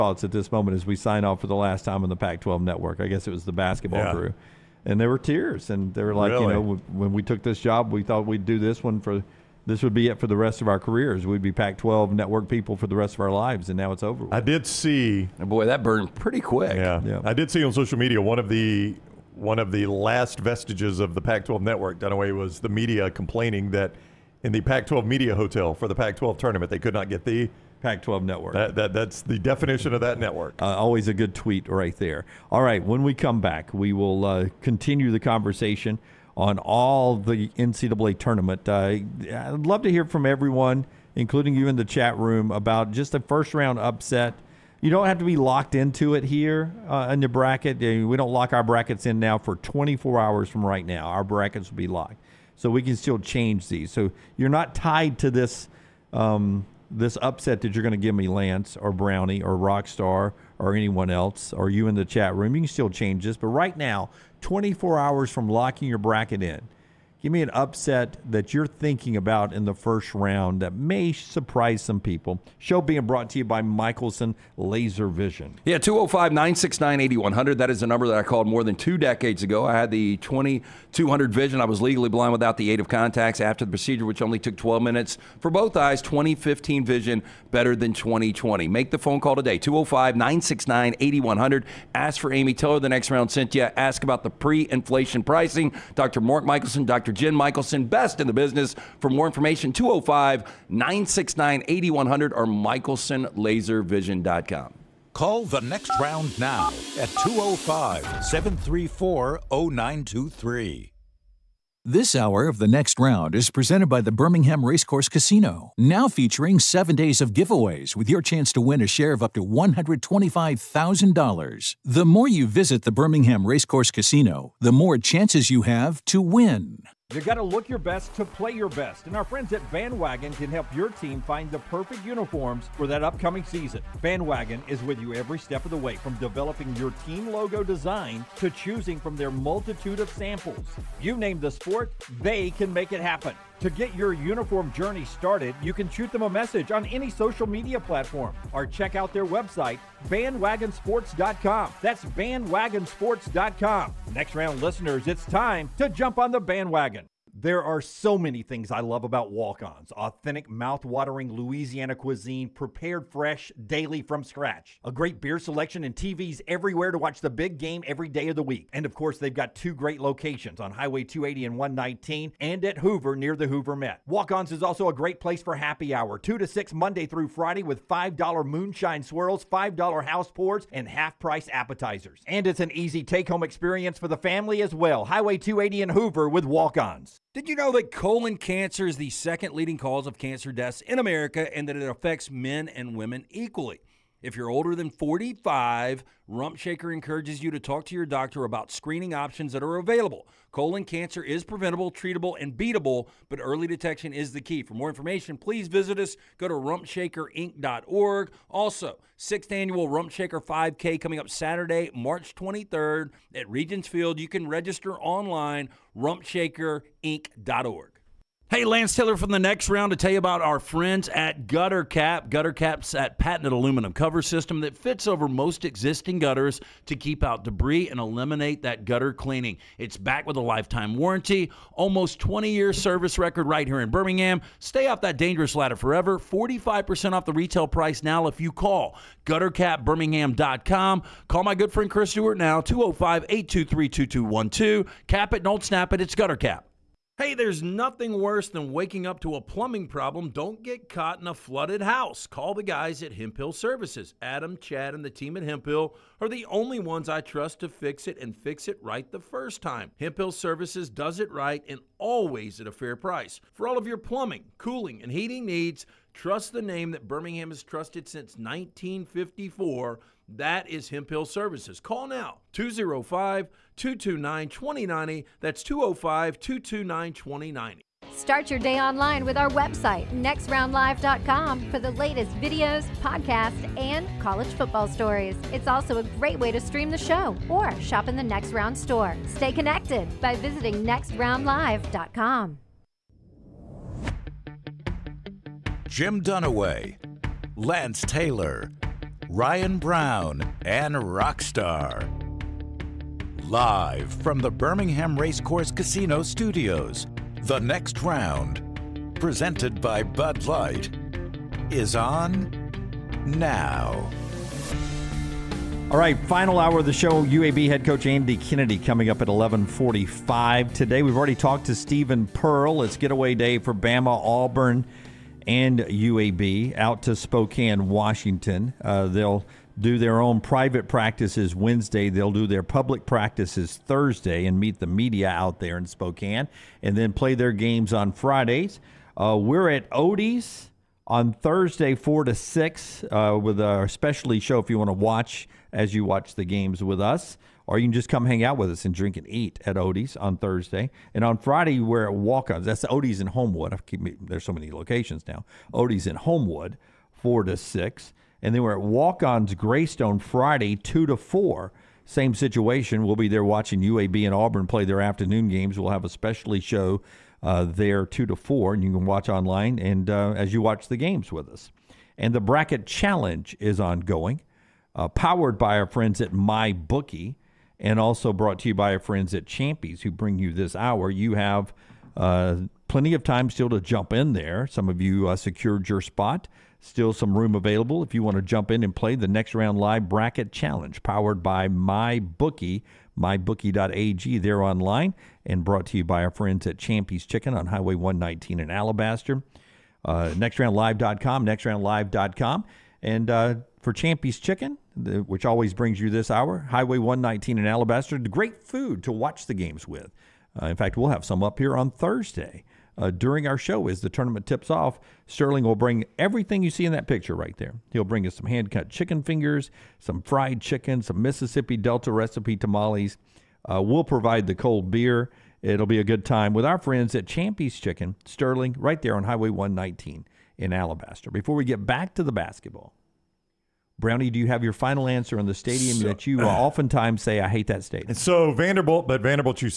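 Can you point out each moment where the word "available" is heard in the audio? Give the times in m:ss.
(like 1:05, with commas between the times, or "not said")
3:19, 6:27.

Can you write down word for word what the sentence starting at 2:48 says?
And of course, they've got two great locations on Highway 280 and 119 and at Hoover near the Hoover Met.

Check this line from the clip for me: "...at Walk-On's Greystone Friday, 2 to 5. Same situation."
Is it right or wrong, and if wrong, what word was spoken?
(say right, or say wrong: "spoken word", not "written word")
wrong: "4", not "5".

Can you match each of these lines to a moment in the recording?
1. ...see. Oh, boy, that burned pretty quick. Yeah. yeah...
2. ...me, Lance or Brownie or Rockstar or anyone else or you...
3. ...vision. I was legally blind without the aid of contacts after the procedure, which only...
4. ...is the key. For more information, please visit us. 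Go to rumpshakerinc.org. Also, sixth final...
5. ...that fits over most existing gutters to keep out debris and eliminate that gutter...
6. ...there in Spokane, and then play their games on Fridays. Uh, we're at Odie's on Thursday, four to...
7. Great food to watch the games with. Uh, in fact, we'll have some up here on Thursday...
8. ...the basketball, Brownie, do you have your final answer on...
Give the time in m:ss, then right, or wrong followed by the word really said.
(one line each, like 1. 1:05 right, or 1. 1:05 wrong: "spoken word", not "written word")
1. 0:14 right
2. 0:58 right
3. 1:21 right
4. 3:24 wrong: "annual", not "final"
5. 3:44 right
6. 5:35 right
7. 6:48 right
8. 7:12 right.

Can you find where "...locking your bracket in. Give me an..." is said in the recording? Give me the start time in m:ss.
1:05.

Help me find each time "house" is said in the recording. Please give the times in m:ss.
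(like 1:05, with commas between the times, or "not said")
3:00, 4:11.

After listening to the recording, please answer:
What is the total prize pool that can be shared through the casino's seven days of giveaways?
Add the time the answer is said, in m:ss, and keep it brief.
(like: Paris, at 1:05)
$125,000, at 1:59.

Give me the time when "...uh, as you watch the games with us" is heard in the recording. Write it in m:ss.
6:10.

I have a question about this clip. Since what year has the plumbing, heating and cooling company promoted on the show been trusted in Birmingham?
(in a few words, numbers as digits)
1954.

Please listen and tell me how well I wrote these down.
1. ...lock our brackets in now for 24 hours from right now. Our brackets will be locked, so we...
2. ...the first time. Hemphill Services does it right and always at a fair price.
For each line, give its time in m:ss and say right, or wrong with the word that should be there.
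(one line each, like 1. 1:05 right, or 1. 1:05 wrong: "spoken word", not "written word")
1. 0:48 right
2. 4:19 right.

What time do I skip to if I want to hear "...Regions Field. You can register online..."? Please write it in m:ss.
3:33.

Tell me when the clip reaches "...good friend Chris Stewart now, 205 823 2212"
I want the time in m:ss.
4:01.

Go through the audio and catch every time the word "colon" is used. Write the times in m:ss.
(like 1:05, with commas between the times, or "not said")
3:07, 3:20.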